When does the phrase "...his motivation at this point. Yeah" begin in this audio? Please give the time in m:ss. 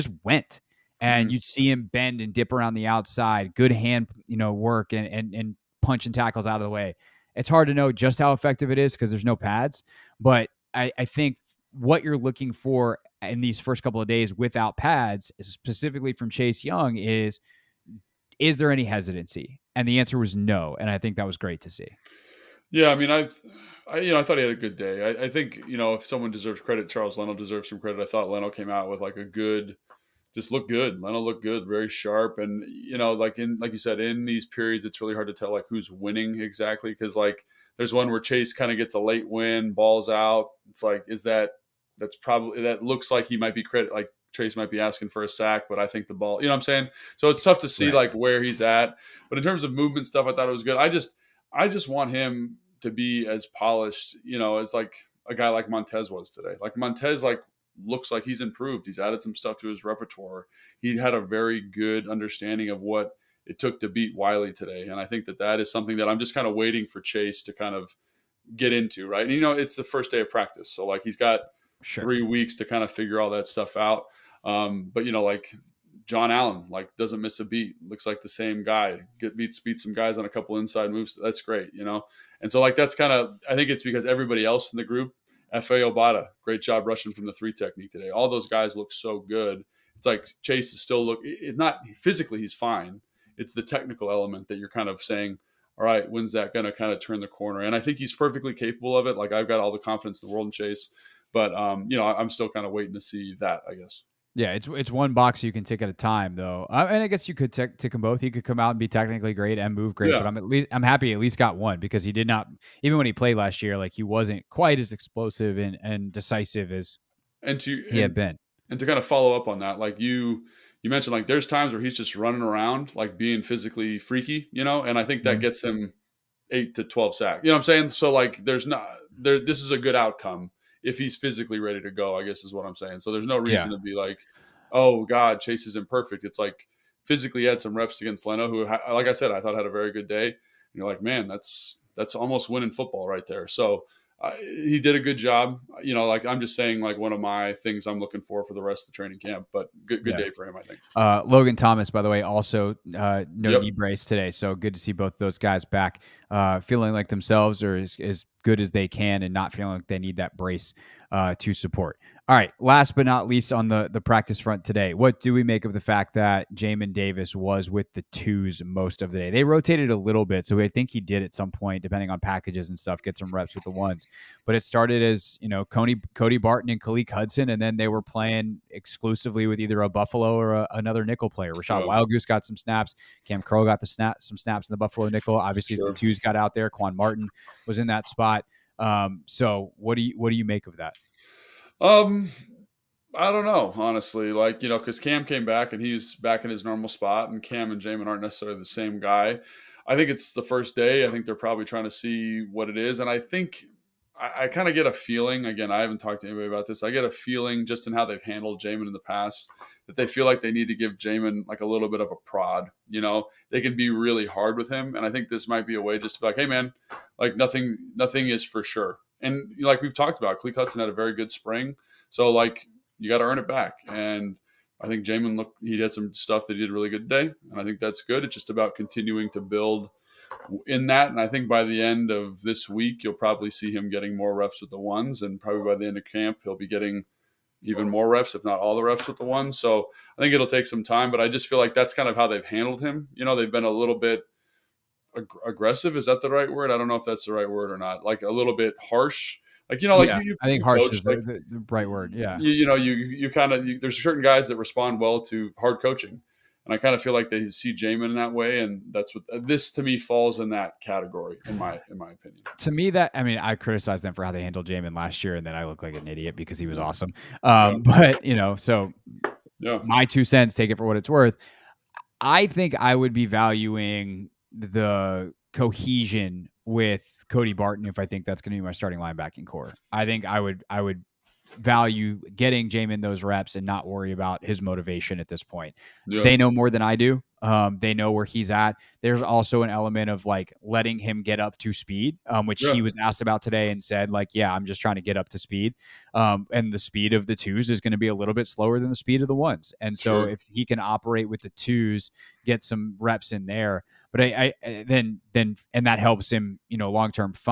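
4:44.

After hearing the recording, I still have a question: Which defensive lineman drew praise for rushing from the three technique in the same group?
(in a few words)
Efe Obada.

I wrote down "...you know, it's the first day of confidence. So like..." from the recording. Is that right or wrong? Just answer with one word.
wrong.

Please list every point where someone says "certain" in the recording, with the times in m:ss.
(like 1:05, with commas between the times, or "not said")
4:14.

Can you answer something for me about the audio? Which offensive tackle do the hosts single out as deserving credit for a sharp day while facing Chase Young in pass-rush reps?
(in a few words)
Charles Leno.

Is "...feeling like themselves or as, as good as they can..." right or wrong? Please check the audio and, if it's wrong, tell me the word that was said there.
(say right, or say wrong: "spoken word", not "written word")
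right.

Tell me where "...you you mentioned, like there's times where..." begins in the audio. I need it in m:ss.
1:59.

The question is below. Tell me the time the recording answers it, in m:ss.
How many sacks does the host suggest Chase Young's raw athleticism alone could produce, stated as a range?
2:06.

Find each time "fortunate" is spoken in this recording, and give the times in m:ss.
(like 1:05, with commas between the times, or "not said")
not said.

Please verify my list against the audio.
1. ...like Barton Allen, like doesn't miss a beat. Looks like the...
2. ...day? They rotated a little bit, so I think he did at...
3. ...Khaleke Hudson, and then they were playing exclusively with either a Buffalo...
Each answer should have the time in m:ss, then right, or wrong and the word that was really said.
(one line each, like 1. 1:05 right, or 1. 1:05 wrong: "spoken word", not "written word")
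1. 1:15 wrong: "John", not "Barton"
2. 2:49 right
3. 2:56 right.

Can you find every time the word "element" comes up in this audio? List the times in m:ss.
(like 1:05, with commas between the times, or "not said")
1:34, 4:49.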